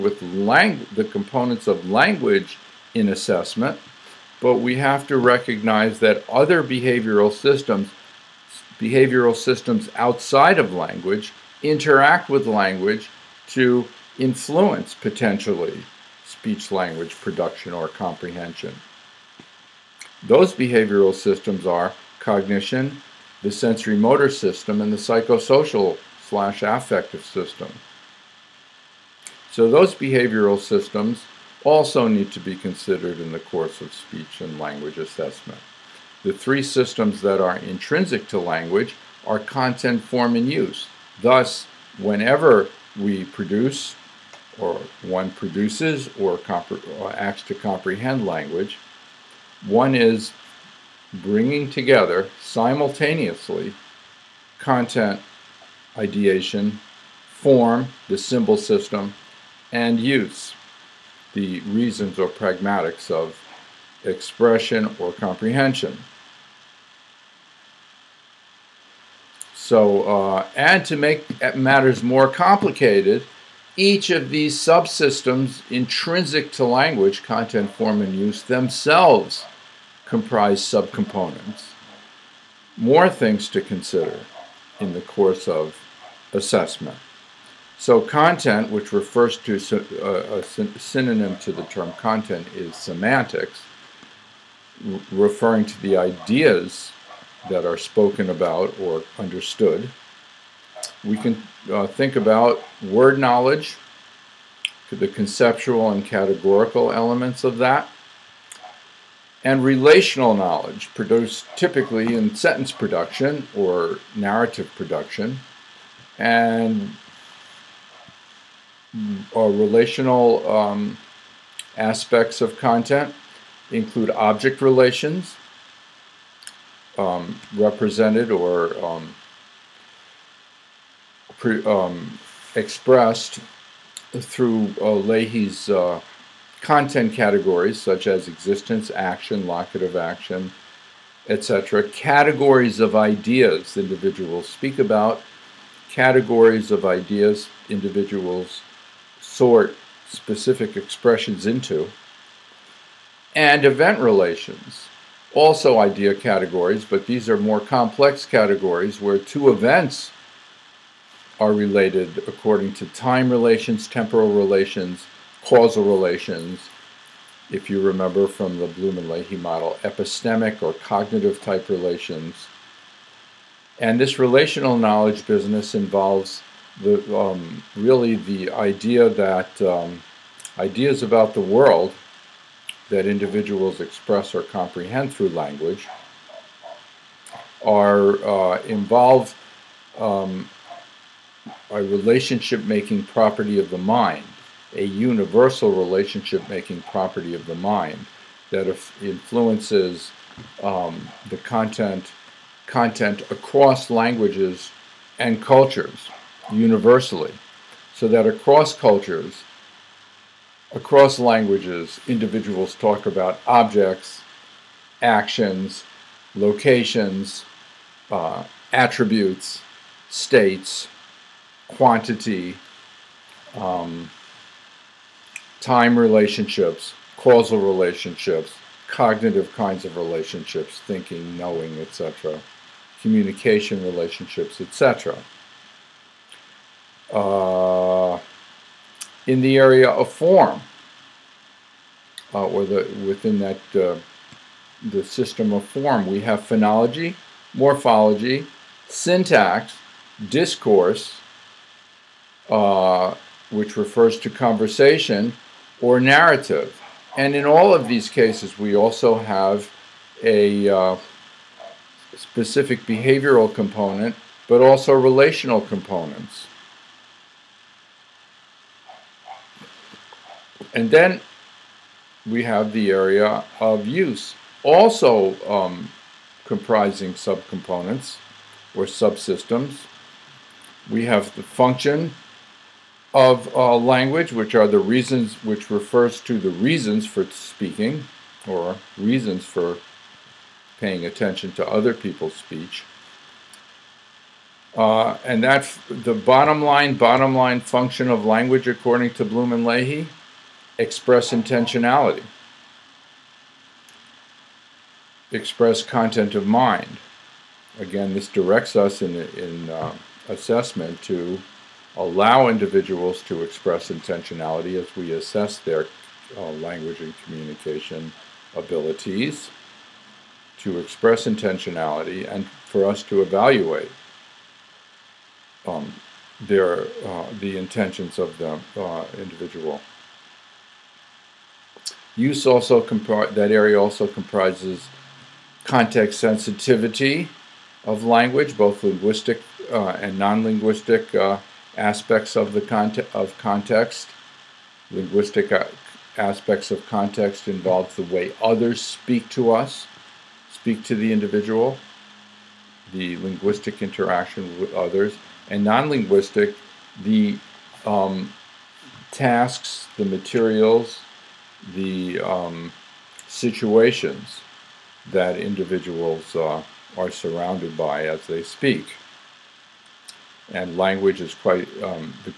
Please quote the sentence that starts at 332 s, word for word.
Use also that area also comprises context sensitivity of language, both linguistic uh, and non-linguistic uh, aspects of the conte of context.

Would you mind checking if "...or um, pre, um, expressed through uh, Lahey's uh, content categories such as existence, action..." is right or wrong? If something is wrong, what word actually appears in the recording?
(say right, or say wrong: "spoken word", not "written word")
right.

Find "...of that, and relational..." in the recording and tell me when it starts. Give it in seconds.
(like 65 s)
107 s.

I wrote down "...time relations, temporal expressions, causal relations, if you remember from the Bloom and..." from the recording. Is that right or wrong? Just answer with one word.
wrong.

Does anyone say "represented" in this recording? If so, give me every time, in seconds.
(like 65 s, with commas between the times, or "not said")
127 s.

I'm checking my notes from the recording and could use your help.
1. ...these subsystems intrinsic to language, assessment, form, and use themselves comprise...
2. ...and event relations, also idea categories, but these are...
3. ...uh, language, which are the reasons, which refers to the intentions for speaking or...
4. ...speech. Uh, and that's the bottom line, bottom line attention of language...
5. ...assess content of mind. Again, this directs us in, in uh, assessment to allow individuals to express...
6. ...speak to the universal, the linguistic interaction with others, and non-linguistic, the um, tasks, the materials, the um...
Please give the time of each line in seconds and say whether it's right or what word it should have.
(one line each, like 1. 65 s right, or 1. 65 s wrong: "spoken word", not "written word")
1. 74 s wrong: "content", not "assessment"
2. 153 s right
3. 283 s wrong: "reasons", not "intentions"
4. 292 s wrong: "function", not "attention"
5. 305 s wrong: "express", not "assess"
6. 350 s wrong: "individual", not "universal".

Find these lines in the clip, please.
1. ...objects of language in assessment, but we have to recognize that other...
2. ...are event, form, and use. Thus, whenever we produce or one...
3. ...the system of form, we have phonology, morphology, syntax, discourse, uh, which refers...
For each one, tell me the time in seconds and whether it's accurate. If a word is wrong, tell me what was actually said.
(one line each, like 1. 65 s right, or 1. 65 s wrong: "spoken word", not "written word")
1. 1 s wrong: "components", not "objects"
2. 39 s wrong: "content", not "event"
3. 244 s right.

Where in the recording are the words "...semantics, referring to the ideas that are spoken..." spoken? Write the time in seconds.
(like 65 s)
92 s.